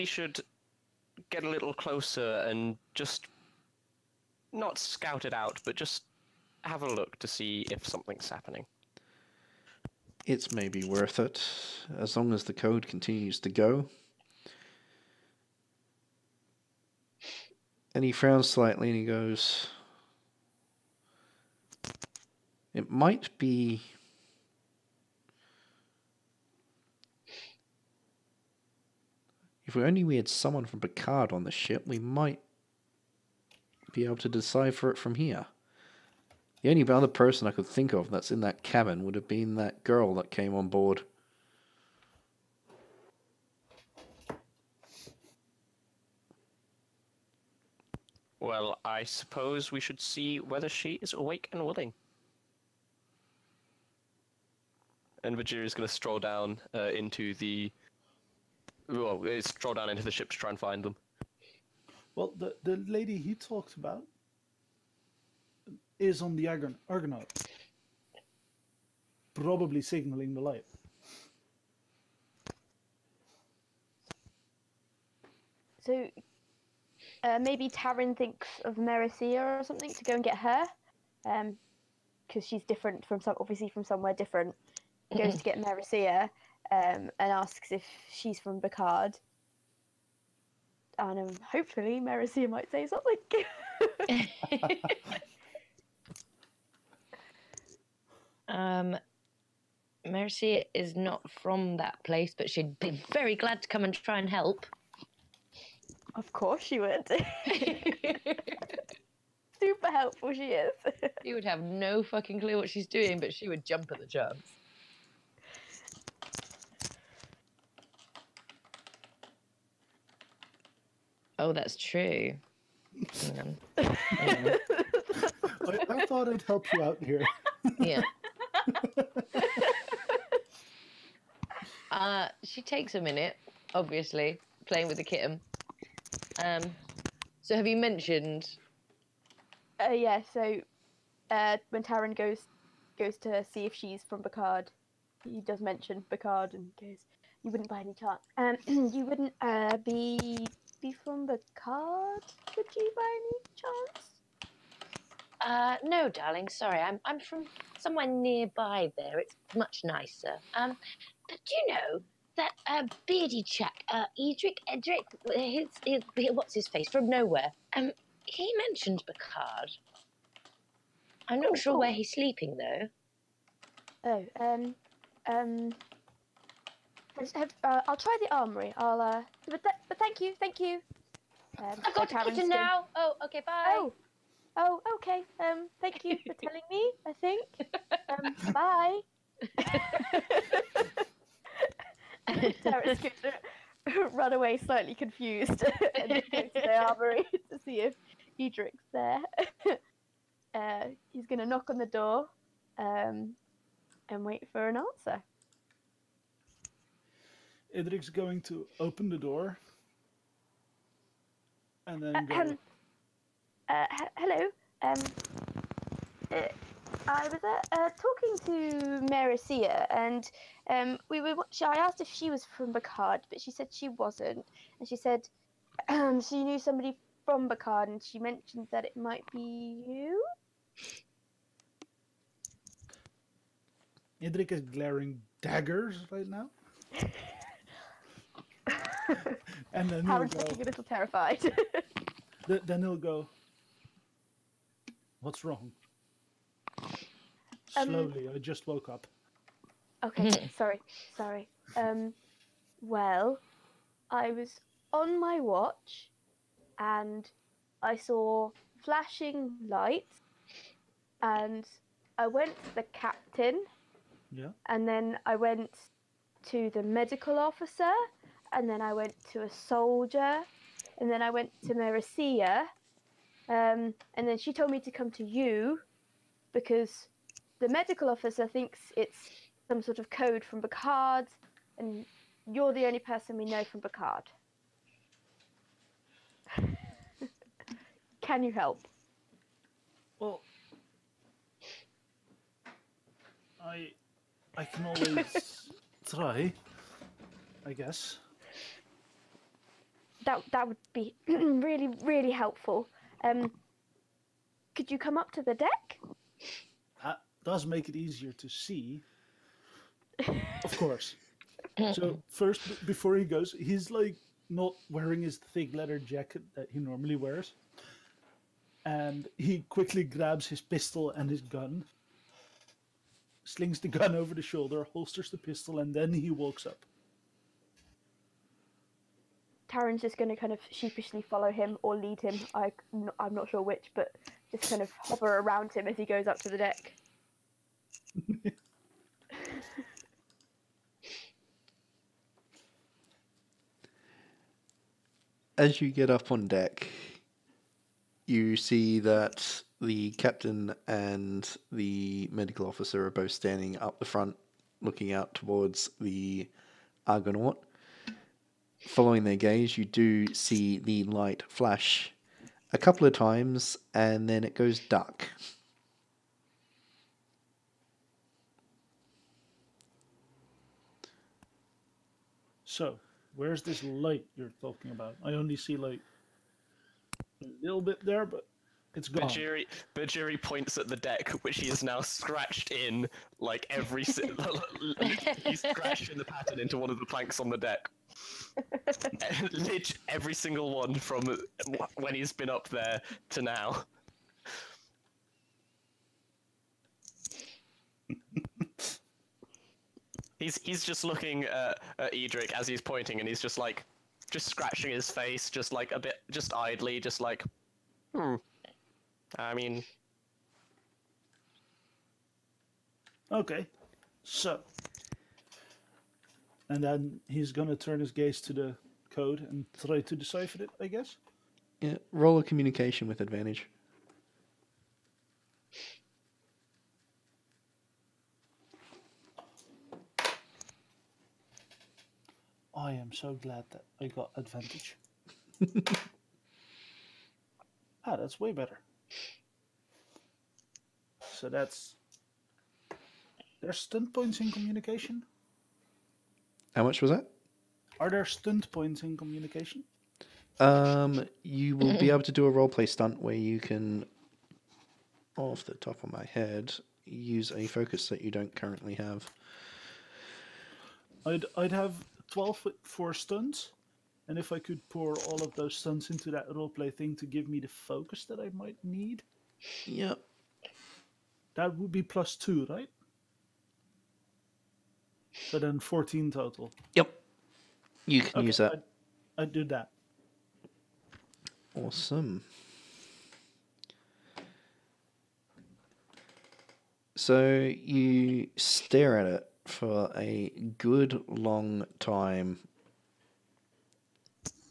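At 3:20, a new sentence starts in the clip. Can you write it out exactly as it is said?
uh, he's going to knock on the door um, and wait for an answer.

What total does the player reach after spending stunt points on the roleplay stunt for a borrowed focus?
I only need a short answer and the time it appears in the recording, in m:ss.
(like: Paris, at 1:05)
14, at 7:55.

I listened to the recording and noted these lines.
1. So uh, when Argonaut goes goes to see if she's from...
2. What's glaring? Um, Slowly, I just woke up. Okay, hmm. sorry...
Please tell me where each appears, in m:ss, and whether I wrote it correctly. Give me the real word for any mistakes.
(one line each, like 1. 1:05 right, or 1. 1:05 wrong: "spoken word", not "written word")
1. 2:20 wrong: "Taryn", not "Argonaut"
2. 4:05 wrong: "wrong", not "glaring".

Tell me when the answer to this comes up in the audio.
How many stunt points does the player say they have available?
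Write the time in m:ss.
7:42.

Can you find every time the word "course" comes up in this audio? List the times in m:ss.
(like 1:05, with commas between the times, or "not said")
1:46, 5:10.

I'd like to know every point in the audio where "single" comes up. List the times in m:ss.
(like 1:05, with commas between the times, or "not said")
6:24, 6:30.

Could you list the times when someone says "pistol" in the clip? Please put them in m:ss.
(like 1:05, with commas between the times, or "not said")
5:20, 5:25.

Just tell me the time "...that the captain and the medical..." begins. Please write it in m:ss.
5:48.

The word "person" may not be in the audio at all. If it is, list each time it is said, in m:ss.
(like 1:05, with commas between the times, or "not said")
0:37, 4:42.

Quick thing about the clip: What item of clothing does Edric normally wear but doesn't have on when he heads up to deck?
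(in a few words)
thick leather jacket.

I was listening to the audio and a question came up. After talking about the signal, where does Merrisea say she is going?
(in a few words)
kitchen.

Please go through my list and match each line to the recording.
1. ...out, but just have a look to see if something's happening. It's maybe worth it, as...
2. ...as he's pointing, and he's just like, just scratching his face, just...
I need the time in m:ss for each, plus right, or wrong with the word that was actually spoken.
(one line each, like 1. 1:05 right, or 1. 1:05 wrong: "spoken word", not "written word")
1. 0:05 right
2. 6:42 right.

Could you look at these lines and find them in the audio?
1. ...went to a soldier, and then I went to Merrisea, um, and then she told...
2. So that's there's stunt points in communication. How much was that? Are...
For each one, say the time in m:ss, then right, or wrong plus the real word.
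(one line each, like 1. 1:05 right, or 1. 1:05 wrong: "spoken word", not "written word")
1. 4:28 right
2. 7:21 right.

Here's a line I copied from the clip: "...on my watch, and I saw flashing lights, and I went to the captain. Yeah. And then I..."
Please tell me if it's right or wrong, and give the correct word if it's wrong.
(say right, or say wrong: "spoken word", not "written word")
right.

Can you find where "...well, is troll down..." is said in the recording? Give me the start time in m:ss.
0:58.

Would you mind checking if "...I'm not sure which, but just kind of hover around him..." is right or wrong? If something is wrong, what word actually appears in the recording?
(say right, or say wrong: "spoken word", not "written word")
right.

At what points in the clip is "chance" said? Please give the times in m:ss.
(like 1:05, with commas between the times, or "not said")
1:54, 2:27, 2:33.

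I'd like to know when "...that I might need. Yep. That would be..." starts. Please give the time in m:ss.
7:48.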